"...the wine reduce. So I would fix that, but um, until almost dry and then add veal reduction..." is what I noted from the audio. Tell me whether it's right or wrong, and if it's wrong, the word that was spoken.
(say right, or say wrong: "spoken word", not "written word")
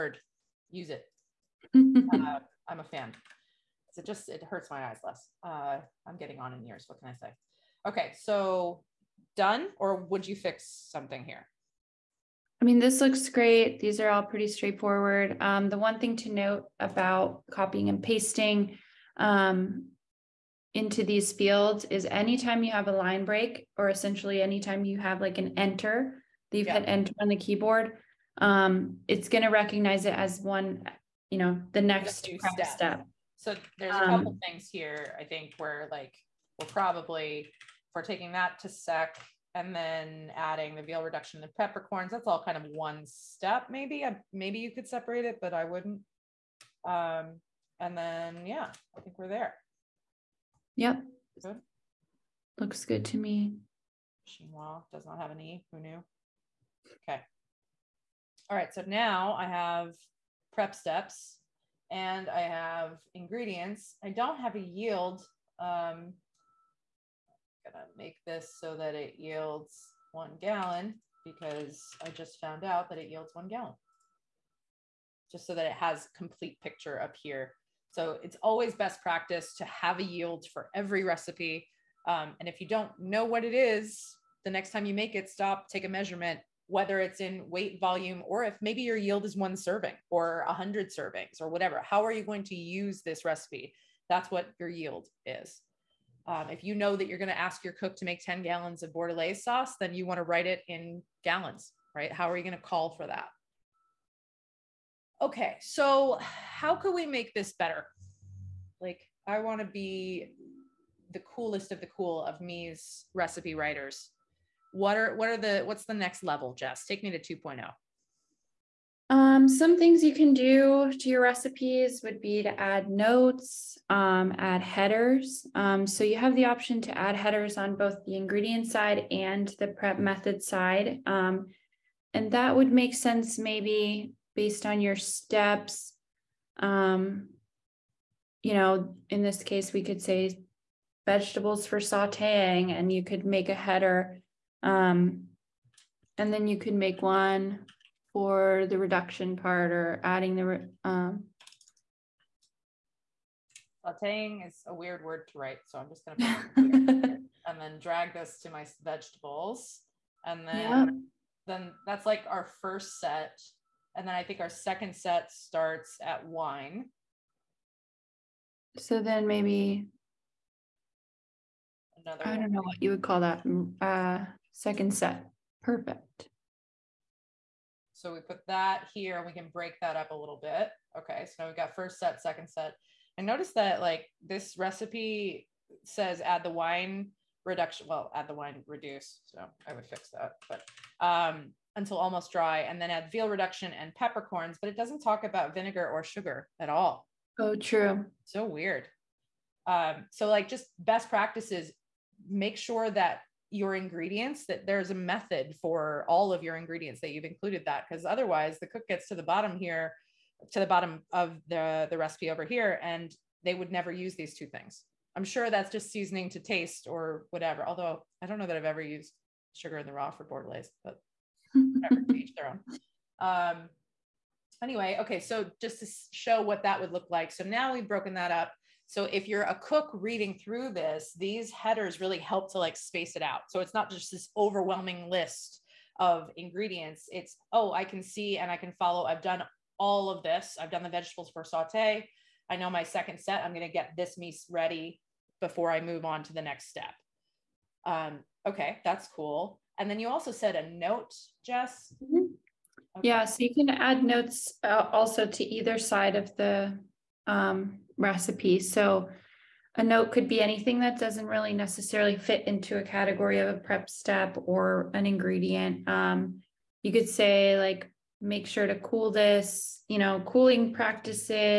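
right.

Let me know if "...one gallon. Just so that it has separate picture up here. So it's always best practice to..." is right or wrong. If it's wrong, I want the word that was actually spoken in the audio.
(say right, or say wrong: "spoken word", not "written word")
wrong: "complete", not "separate".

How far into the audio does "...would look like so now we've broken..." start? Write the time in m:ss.
3:46.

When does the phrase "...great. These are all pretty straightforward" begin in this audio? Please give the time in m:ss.
0:13.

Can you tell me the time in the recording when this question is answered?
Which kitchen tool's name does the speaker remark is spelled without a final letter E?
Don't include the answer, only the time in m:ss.
0:54.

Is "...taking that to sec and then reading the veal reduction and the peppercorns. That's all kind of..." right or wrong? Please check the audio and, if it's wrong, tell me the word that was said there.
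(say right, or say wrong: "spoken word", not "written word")
wrong: "adding", not "reading".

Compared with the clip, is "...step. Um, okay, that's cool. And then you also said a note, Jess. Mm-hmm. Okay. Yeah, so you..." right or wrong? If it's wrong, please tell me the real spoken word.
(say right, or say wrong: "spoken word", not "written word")
right.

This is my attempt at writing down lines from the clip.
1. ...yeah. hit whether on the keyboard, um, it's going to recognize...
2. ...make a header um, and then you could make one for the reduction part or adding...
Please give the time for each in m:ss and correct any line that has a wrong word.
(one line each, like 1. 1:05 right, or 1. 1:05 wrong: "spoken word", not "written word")
1. 0:26 wrong: "enter", not "whether"
2. 2:23 right.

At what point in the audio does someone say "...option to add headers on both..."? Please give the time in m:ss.
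2:06.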